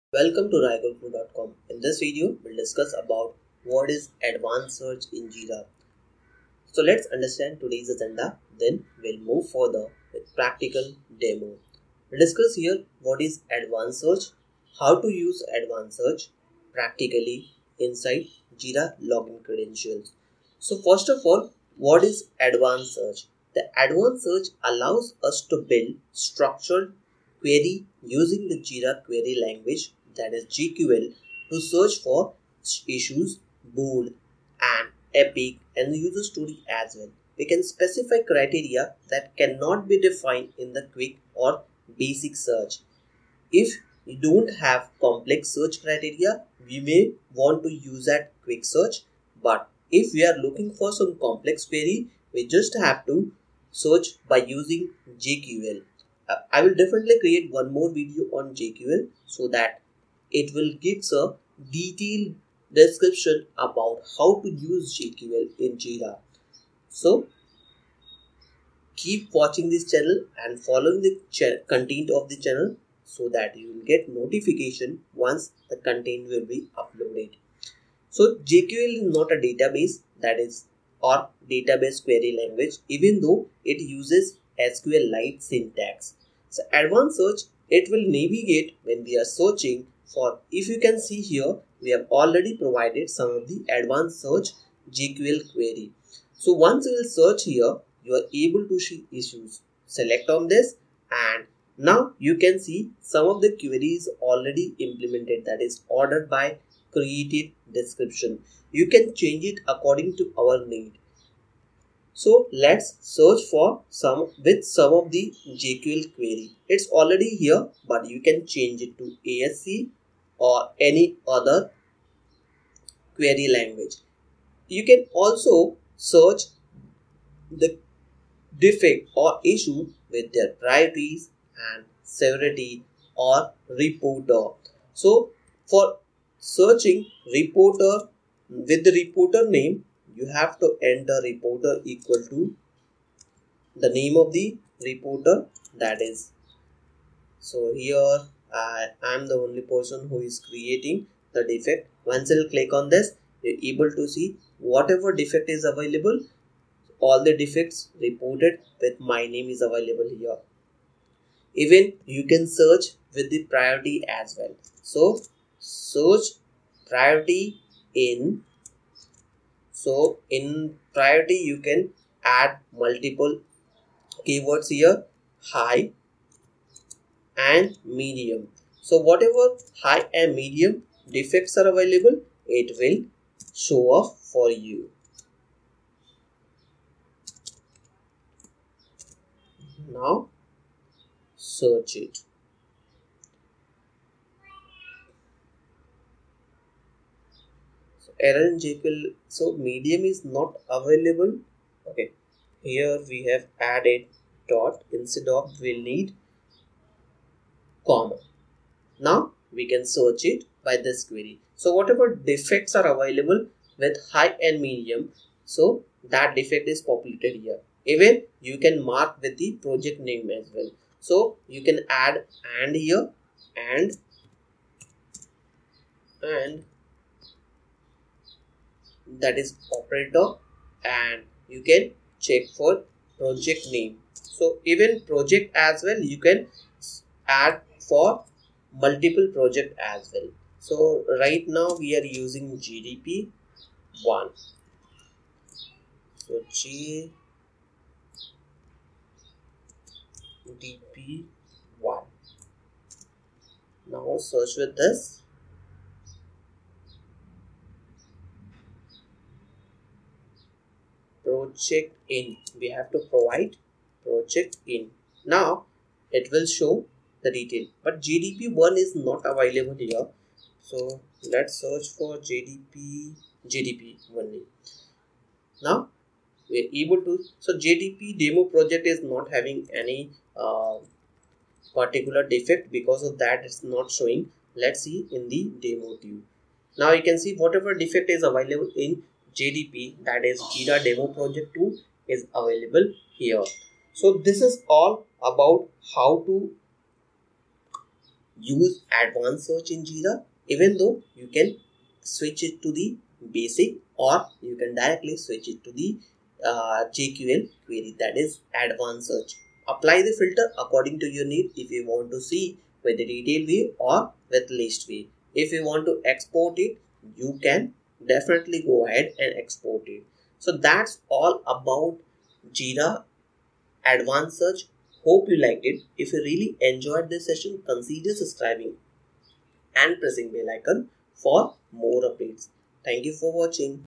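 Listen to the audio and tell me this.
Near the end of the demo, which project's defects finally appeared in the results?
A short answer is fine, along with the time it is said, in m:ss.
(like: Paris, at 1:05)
Jira Demo Project 2, at 4:50.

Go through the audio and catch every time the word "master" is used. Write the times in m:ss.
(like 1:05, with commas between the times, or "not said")
not said.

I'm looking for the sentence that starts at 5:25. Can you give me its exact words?
If you really enjoyed this session, consider subscribing and pressing bell icon for more updates.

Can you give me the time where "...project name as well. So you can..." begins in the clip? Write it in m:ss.
3:39.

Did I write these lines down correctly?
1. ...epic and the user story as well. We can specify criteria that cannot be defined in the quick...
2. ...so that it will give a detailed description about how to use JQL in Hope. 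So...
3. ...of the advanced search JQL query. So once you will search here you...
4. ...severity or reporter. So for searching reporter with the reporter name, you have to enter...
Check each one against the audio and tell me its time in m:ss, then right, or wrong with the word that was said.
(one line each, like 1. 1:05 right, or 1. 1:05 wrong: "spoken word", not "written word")
1. 0:35 right
2. 0:59 wrong: "Jira", not "Hope"
3. 1:33 right
4. 2:12 right.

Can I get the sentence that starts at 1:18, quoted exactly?
So JQL is not a database that is or database query language even though it uses SQL-like syntax.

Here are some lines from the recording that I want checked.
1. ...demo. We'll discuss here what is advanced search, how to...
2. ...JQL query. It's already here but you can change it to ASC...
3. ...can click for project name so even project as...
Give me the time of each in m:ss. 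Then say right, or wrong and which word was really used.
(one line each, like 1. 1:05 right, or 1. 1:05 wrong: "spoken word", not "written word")
1. 0:11 right
2. 1:55 right
3. 3:51 wrong: "check", not "click".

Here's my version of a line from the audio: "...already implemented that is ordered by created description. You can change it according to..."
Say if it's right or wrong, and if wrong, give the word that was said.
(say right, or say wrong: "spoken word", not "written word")
right.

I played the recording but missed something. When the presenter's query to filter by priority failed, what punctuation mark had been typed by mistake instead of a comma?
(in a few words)
dot.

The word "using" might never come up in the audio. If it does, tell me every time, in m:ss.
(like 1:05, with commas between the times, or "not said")
0:28, 0:54, 4:02.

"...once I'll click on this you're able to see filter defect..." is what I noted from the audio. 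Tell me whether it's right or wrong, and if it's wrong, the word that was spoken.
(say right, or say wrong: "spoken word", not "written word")
wrong: "whatever", not "filter".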